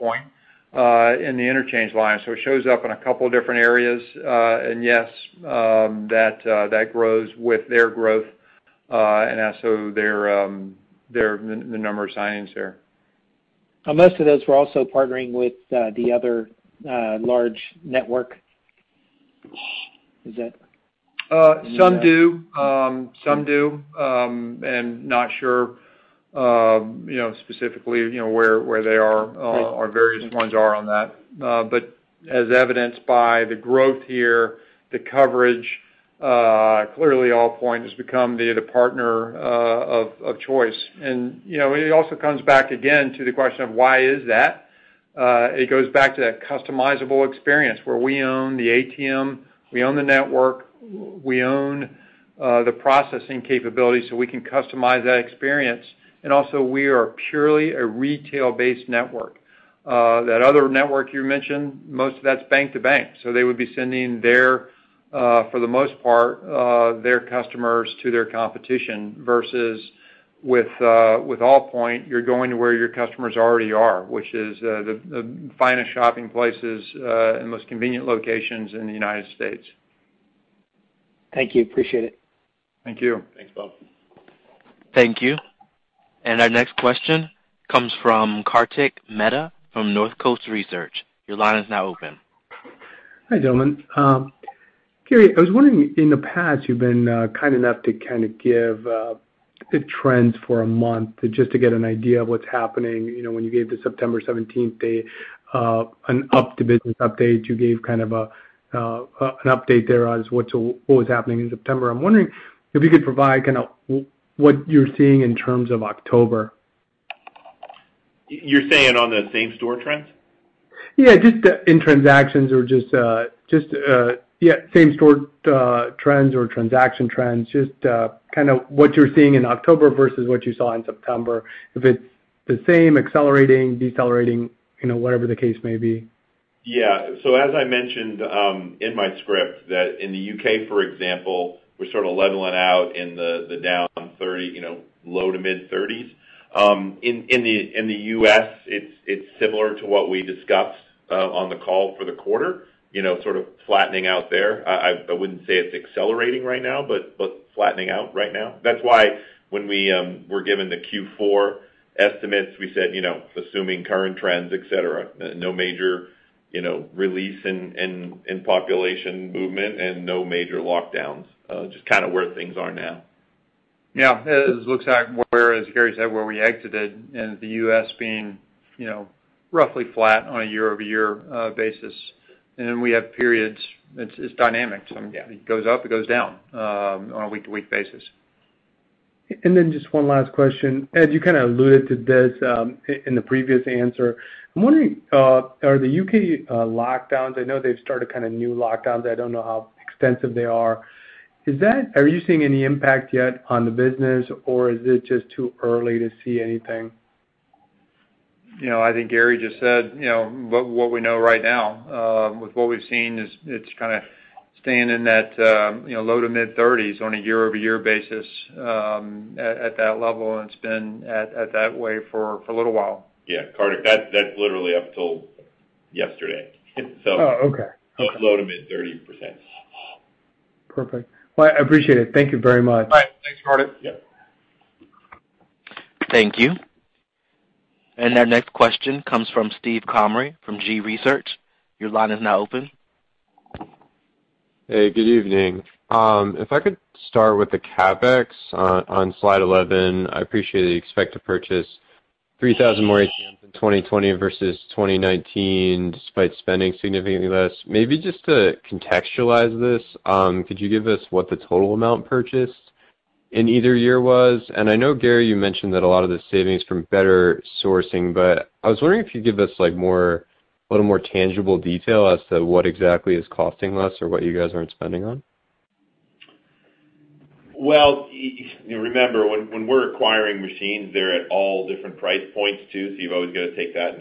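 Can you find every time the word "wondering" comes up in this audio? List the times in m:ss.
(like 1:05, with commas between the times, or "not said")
1:35, 1:52, 3:14, 4:28.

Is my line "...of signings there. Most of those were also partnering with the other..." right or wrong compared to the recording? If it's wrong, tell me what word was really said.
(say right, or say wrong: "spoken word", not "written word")
right.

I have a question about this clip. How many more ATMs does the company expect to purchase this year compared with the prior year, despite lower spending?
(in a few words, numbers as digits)
3,000.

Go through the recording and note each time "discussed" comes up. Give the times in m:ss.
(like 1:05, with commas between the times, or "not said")
2:30.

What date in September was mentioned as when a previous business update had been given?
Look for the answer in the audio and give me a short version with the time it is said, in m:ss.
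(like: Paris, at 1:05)
September 17th, at 1:43.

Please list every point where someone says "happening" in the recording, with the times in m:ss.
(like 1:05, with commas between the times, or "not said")
1:42, 1:51.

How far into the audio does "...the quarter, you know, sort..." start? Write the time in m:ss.
2:32.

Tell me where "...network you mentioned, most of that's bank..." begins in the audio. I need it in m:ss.
1:00.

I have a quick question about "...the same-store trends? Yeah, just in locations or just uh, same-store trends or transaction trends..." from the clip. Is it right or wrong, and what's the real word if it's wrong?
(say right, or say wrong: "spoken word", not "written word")
wrong: "transactions", not "locations".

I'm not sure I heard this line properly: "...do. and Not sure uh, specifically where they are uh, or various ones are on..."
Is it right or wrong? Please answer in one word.
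right.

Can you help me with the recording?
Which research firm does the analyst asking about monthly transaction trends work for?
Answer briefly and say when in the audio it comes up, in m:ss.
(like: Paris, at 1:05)
Northcoast Research, at 1:29.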